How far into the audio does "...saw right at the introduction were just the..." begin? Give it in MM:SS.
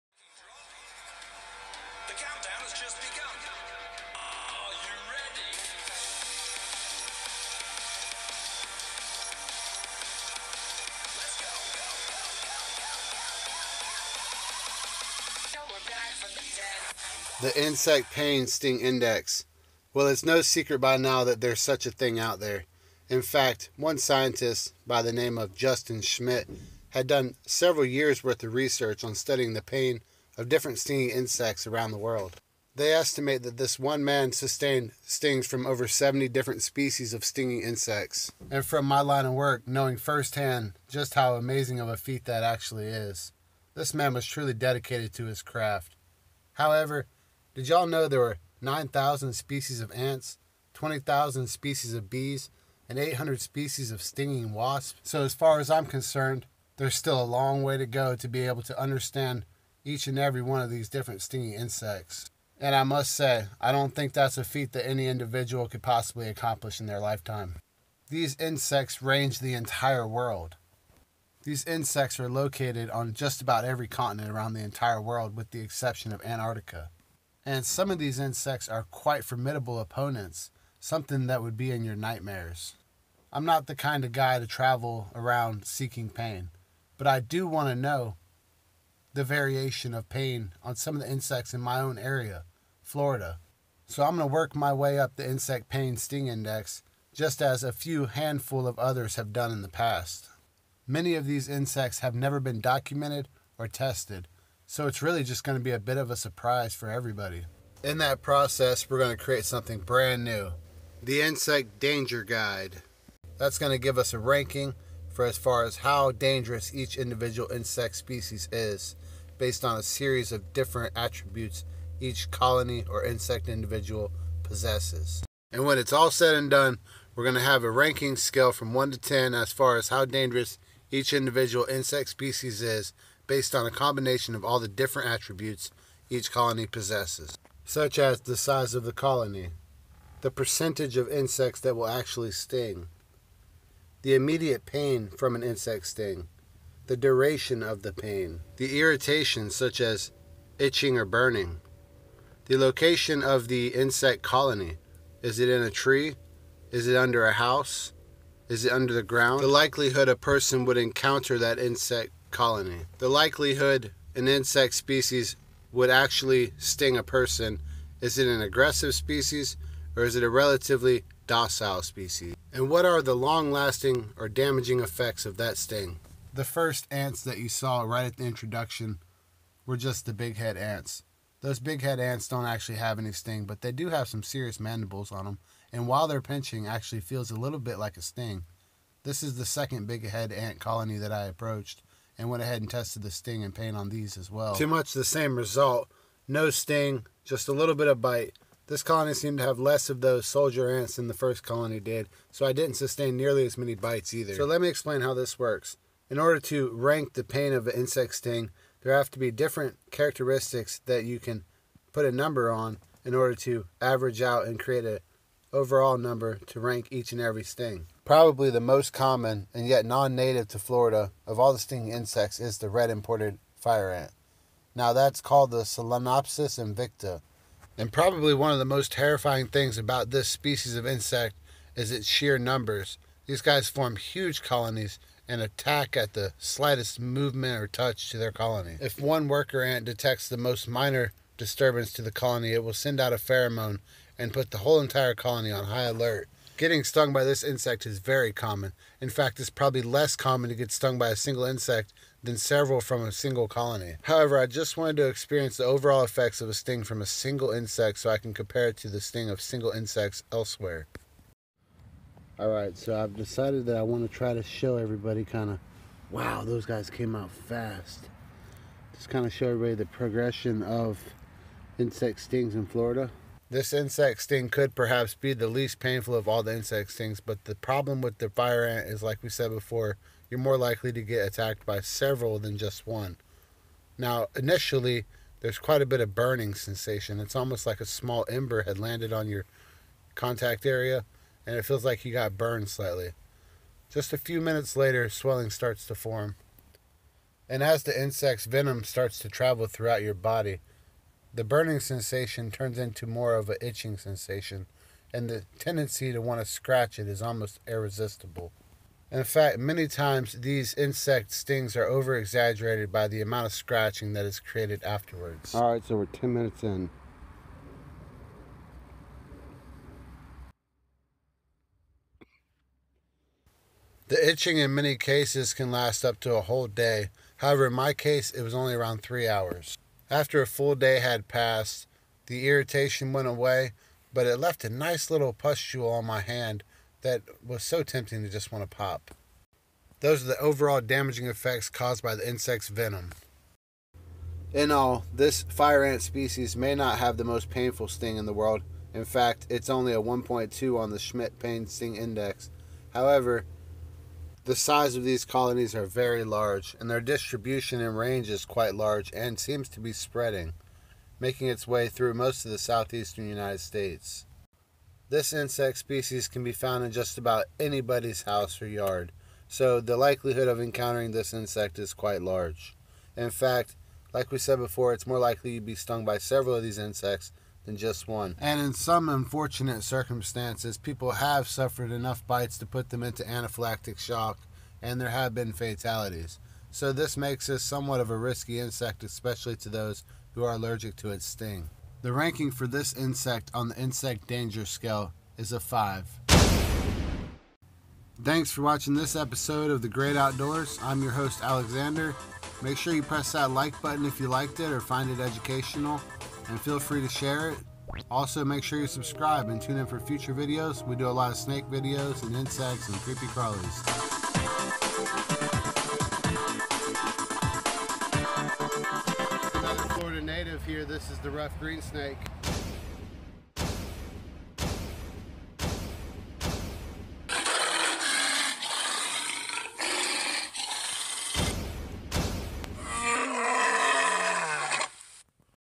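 02:57.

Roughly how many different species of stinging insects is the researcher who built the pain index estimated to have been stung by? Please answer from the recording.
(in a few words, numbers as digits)
over 70.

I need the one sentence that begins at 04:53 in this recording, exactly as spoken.
Just a few minutes later, swelling starts to form.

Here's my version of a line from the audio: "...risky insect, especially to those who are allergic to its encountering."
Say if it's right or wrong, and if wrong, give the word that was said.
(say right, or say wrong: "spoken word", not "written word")
wrong: "sting", not "encountering".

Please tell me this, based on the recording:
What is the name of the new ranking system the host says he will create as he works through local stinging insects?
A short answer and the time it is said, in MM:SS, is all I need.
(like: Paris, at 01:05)
Insect Danger Guide, at 01:51.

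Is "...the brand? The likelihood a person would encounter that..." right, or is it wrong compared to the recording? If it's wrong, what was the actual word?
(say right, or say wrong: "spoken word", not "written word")
wrong: "ground", not "brand".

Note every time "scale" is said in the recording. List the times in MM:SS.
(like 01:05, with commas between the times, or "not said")
02:08, 06:34.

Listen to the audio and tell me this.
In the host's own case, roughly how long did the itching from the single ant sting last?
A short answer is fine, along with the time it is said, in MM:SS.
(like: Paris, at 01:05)
around three hours, at 05:28.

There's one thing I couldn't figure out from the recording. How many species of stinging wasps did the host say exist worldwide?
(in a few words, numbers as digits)
800.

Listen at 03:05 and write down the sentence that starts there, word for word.
And while they're pinching, actually feels a little bit like a sting.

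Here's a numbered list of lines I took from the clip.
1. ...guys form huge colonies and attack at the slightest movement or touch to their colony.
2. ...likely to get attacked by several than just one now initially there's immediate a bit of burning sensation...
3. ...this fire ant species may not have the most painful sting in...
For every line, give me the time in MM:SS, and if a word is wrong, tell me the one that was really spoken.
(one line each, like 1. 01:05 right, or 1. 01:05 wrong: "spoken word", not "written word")
1. 03:53 right
2. 04:40 wrong: "quite", not "immediate"
3. 05:45 right.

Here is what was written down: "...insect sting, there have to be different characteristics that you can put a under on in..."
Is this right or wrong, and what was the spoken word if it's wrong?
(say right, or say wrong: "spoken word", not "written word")
wrong: "number", not "under".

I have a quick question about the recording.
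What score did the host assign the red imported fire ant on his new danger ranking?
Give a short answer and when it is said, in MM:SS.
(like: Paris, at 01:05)
5, at 06:35.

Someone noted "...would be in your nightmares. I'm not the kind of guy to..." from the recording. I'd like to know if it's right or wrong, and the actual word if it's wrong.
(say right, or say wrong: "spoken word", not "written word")
right.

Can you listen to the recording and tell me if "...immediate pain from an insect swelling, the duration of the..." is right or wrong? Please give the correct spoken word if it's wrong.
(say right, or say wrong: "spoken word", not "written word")
wrong: "sting", not "swelling".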